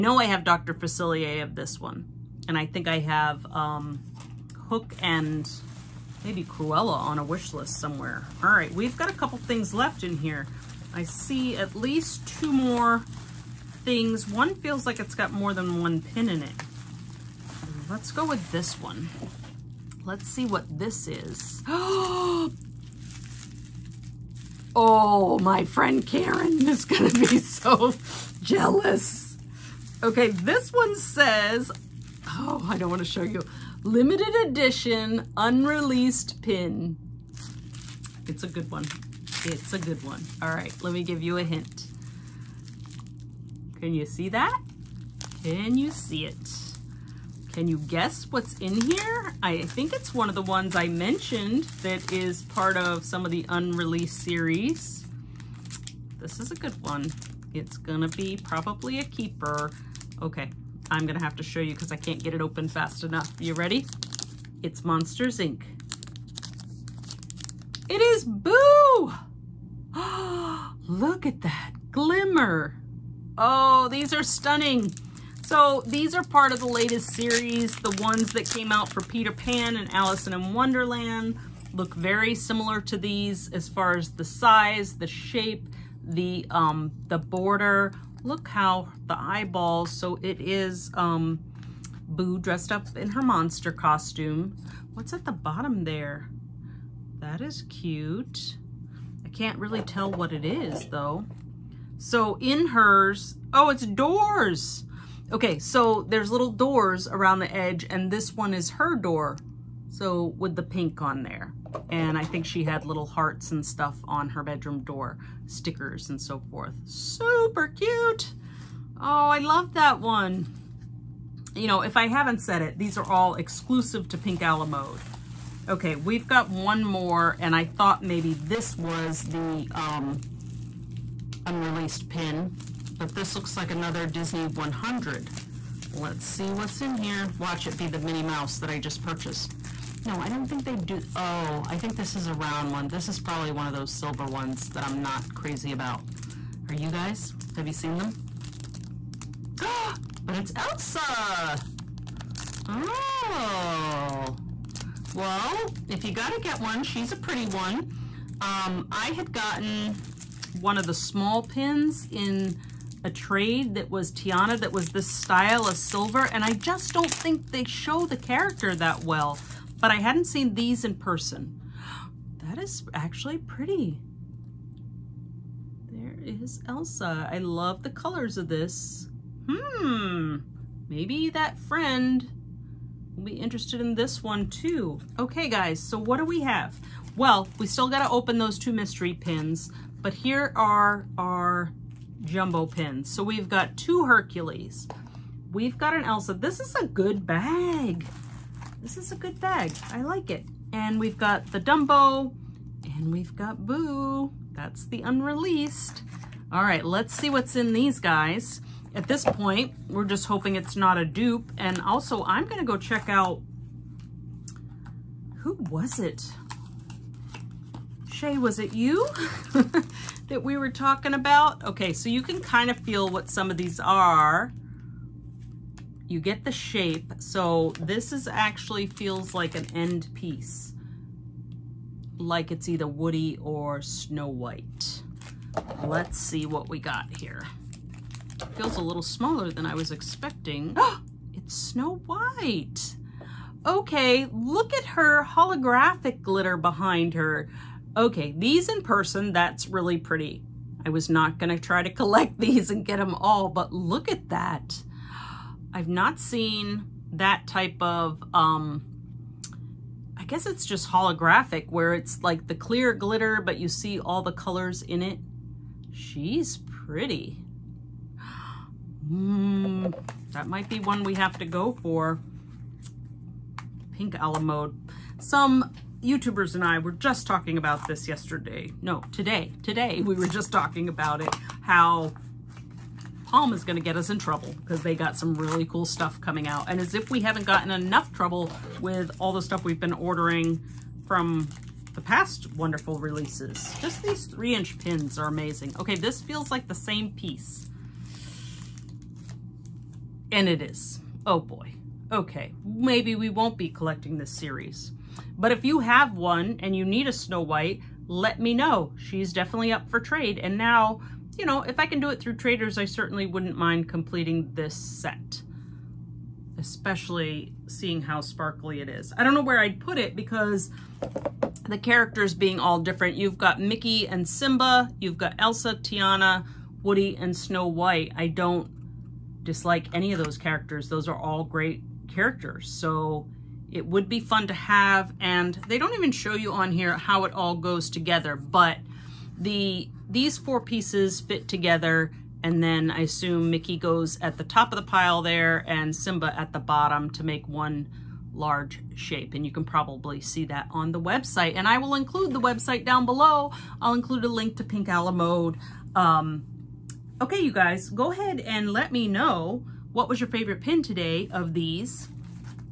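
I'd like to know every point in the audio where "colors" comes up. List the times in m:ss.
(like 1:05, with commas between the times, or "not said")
2:57, 4:24.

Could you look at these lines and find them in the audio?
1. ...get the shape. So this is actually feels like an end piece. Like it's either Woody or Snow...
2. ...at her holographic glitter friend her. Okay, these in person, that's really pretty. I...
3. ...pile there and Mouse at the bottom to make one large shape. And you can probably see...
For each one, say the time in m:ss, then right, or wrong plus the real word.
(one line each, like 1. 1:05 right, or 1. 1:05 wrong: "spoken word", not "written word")
1. 3:46 right
2. 4:04 wrong: "behind", not "friend"
3. 5:44 wrong: "Simba", not "Mouse".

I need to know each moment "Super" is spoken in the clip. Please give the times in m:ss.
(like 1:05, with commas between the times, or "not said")
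1:56.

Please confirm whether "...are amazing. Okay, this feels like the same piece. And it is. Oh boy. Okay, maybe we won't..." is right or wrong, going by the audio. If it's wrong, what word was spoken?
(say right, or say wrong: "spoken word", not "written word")
right.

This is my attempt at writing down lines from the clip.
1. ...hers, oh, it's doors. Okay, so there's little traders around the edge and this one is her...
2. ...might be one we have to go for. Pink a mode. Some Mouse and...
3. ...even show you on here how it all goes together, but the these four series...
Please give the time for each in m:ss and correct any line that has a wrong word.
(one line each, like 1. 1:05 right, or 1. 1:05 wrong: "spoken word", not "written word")
1. 1:42 wrong: "doors", not "traders"
2. 4:30 wrong: "YouTubers", not "Mouse"
3. 5:35 wrong: "pieces", not "series".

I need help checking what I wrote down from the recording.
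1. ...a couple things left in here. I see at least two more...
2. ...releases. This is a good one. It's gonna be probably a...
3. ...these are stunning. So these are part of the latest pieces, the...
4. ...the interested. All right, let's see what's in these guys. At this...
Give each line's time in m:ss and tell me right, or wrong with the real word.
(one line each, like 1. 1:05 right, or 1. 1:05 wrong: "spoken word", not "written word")
1. 0:09 right
2. 0:54 wrong: "series", not "releases"
3. 1:13 wrong: "series", not "pieces"
4. 3:24 wrong: "unreleased", not "interested".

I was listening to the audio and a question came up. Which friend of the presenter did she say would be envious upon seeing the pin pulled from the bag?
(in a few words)
Karen.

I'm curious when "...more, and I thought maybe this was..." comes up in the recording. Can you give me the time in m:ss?
2:06.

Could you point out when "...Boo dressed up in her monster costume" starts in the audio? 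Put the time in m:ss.
1:32.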